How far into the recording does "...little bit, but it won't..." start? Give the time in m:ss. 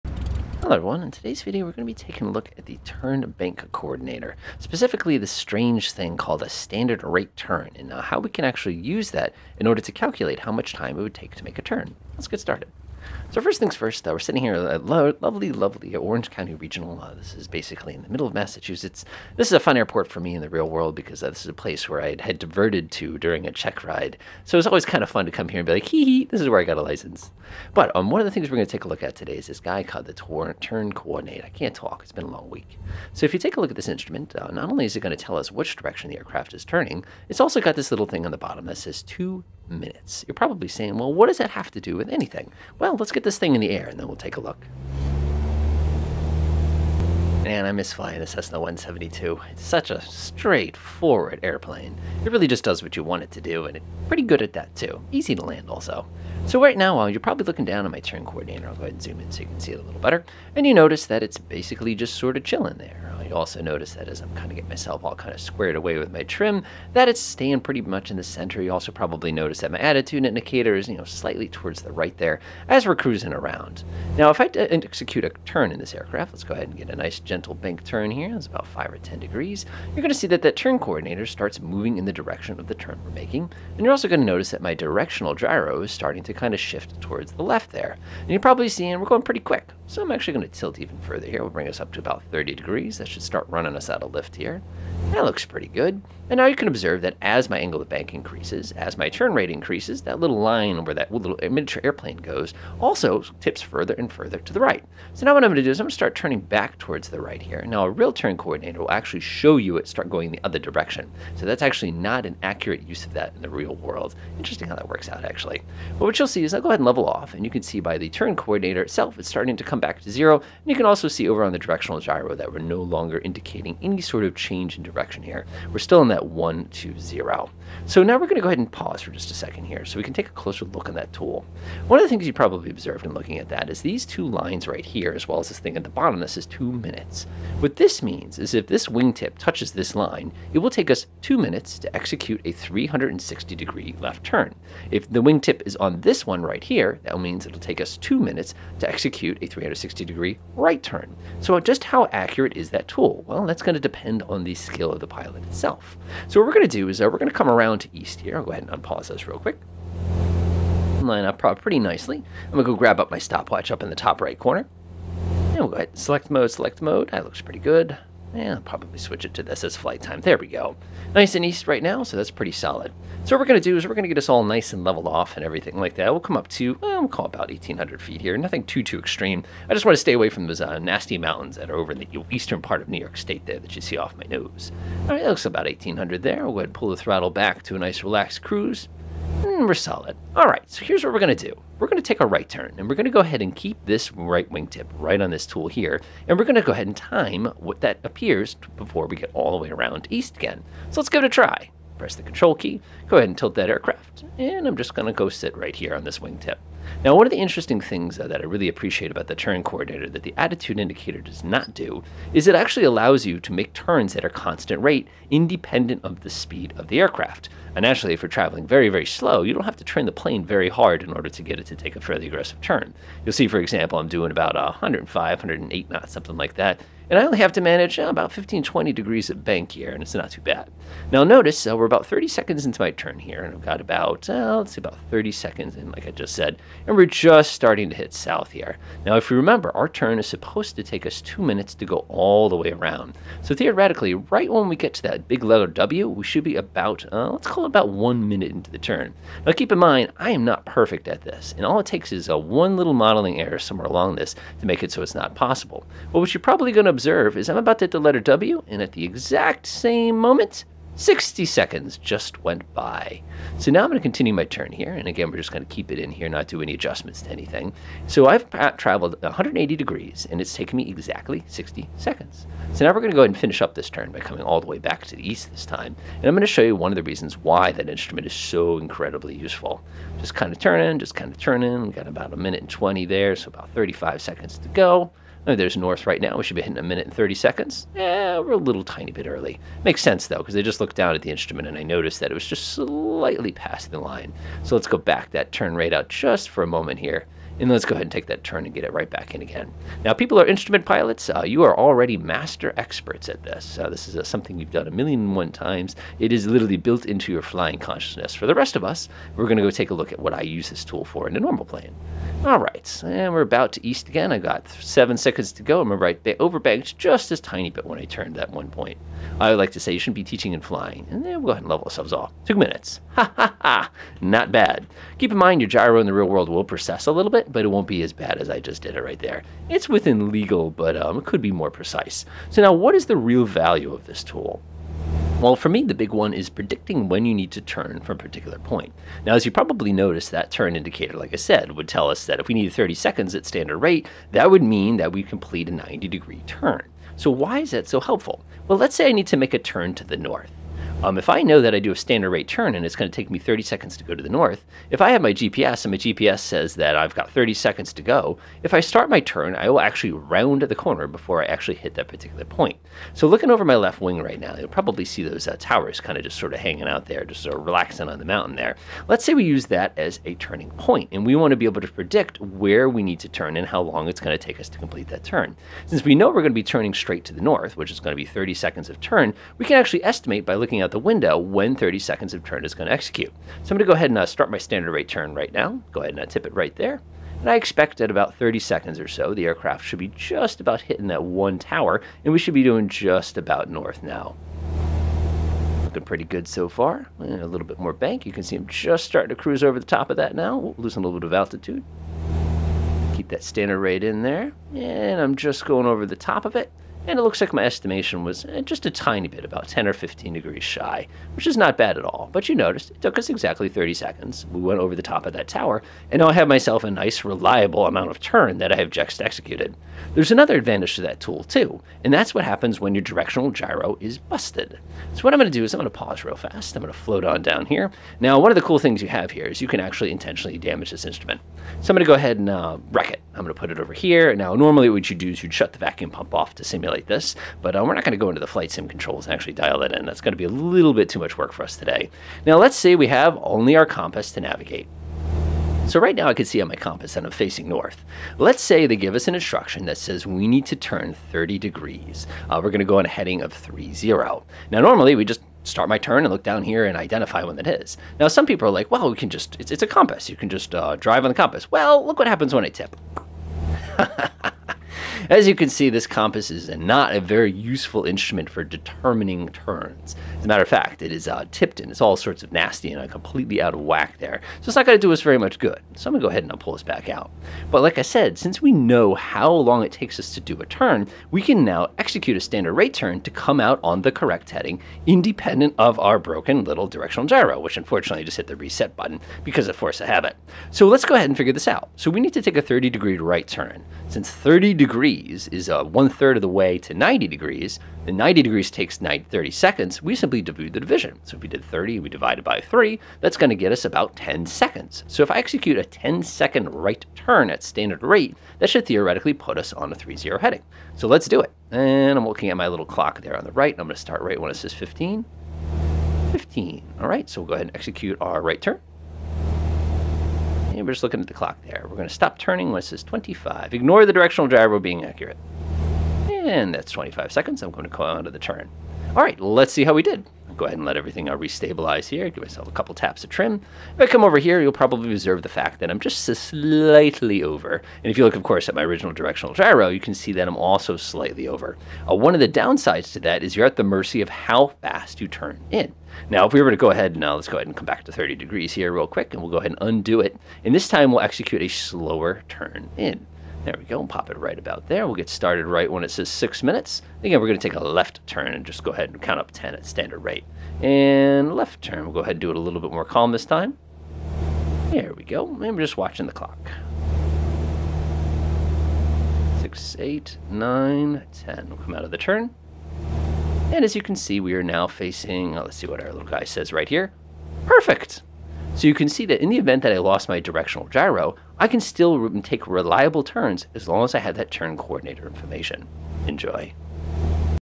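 5:27.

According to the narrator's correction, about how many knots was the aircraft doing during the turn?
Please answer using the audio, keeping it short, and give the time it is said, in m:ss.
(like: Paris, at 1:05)
108 knots, at 3:45.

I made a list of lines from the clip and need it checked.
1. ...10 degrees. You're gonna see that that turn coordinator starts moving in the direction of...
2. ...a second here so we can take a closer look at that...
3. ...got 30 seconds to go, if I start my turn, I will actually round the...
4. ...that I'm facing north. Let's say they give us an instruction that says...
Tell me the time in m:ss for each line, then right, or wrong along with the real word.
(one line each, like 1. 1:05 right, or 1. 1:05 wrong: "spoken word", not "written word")
1. 1:18 right
2. 2:09 right
3. 5:57 right
4. 7:27 right.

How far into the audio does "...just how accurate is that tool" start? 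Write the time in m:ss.
2:31.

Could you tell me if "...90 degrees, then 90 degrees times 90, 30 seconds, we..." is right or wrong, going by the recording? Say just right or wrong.
wrong.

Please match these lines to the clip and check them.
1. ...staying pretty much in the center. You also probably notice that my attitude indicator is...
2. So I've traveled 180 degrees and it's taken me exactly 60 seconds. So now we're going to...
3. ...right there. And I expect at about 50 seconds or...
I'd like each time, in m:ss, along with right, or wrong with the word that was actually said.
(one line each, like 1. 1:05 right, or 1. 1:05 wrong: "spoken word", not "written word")
1. 1:07 right
2. 4:28 right
3. 6:26 wrong: "30", not "50".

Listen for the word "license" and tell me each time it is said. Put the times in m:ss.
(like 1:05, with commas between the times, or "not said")
0:26.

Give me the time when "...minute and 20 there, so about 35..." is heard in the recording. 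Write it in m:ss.
4:42.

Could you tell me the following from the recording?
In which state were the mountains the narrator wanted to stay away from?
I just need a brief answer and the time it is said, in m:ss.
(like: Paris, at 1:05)
New York State, at 3:02.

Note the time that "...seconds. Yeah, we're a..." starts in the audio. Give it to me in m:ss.
4:47.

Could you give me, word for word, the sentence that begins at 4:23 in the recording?
So now I'm going to continue my turn here.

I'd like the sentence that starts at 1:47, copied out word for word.
Now a real turn coordinator will actually show you it start going the other direction.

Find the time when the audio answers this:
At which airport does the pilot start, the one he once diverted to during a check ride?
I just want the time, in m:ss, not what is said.
0:15.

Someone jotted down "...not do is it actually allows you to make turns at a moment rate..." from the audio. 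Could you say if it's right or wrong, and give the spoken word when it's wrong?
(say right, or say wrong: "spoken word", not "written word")
wrong: "constant", not "moment".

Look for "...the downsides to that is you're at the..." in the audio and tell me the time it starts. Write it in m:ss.
9:02.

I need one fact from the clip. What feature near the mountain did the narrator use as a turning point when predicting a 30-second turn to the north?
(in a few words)
towers.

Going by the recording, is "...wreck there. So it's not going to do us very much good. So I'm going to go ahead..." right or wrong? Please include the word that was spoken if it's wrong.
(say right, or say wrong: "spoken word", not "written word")
wrong: "whack", not "wreck".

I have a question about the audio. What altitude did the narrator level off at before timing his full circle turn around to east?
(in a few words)
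1,800 feet.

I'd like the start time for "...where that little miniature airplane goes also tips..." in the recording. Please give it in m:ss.
1:40.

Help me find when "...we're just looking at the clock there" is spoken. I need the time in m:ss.
8:40.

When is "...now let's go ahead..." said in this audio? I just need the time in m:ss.
9:07.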